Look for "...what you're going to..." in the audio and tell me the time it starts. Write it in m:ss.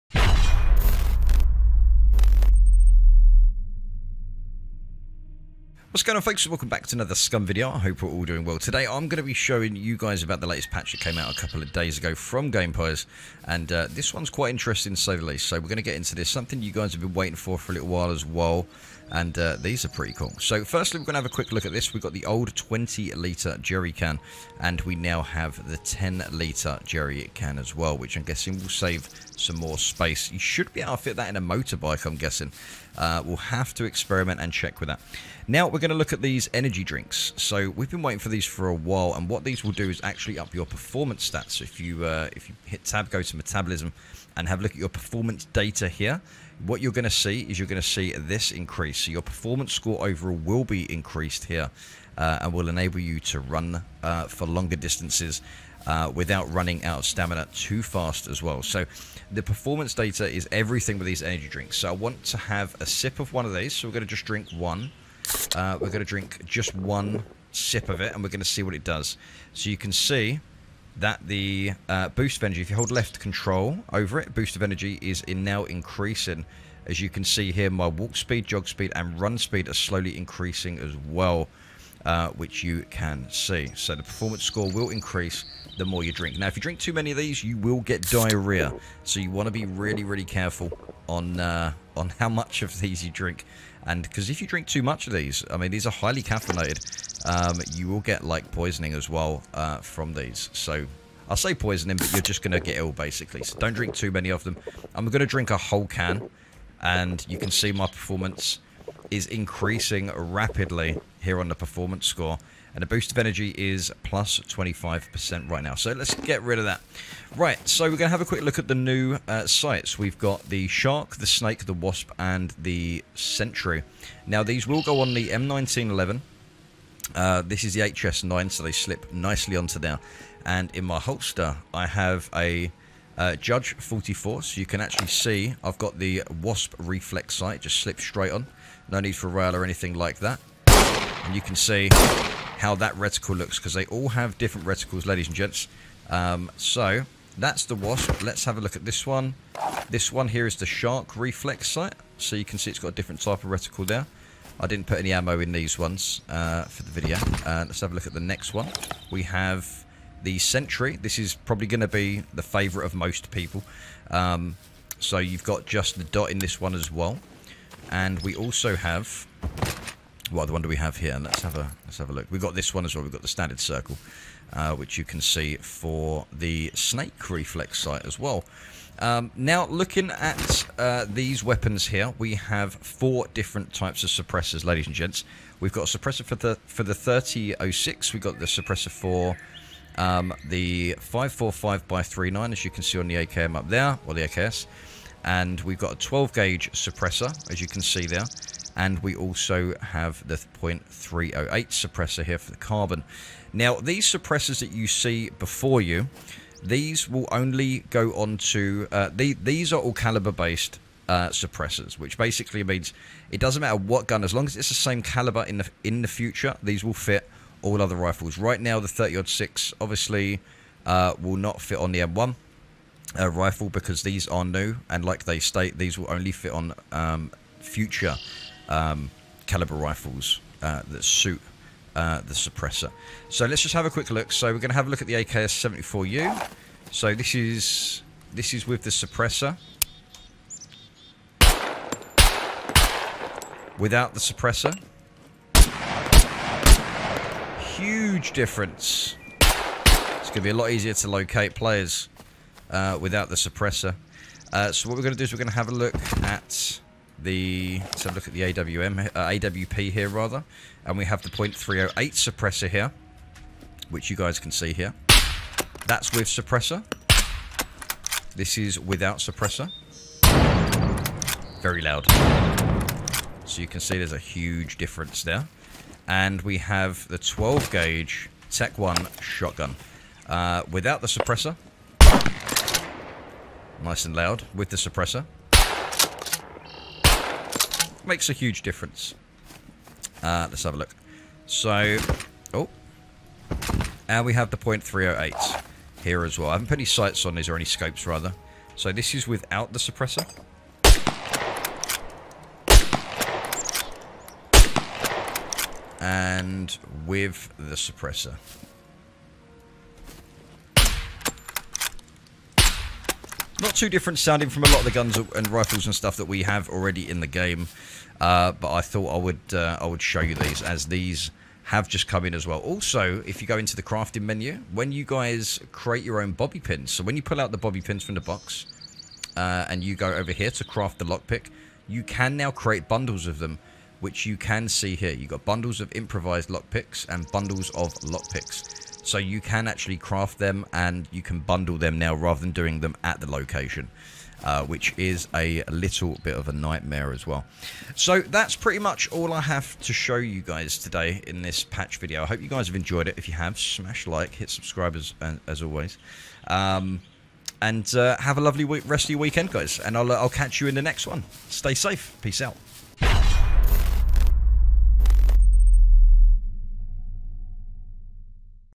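0:46.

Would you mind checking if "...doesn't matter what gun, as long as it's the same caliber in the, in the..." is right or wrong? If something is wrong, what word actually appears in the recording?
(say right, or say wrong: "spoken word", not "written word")
right.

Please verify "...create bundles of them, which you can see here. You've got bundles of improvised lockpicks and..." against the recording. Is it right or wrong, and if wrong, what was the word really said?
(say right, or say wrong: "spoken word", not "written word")
right.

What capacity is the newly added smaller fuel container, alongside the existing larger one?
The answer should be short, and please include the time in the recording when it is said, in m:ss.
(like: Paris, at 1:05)
10 litre, at 0:25.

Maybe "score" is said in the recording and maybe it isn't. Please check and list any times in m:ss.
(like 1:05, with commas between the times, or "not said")
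0:49, 1:24, 1:52.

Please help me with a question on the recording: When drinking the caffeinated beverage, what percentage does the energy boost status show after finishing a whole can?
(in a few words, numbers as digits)
25%.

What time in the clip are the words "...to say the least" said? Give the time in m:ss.
0:14.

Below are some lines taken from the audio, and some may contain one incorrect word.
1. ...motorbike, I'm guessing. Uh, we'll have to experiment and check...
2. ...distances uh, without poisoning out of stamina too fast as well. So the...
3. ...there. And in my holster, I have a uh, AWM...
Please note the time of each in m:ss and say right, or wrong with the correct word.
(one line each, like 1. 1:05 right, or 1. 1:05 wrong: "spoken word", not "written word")
1. 0:31 right
2. 0:54 wrong: "running", not "poisoning"
3. 2:09 wrong: "Judge", not "AWM".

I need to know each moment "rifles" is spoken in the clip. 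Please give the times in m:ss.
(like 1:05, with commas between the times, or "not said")
3:37, 3:43, 3:49, 5:15.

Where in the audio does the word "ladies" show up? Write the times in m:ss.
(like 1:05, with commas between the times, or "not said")
2:25, 3:04.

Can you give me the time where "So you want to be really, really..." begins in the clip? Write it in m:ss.
1:29.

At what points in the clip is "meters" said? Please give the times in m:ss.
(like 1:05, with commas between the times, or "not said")
not said.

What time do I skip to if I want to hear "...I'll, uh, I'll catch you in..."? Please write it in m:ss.
5:59.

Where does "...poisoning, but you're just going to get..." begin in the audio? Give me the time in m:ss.
1:41.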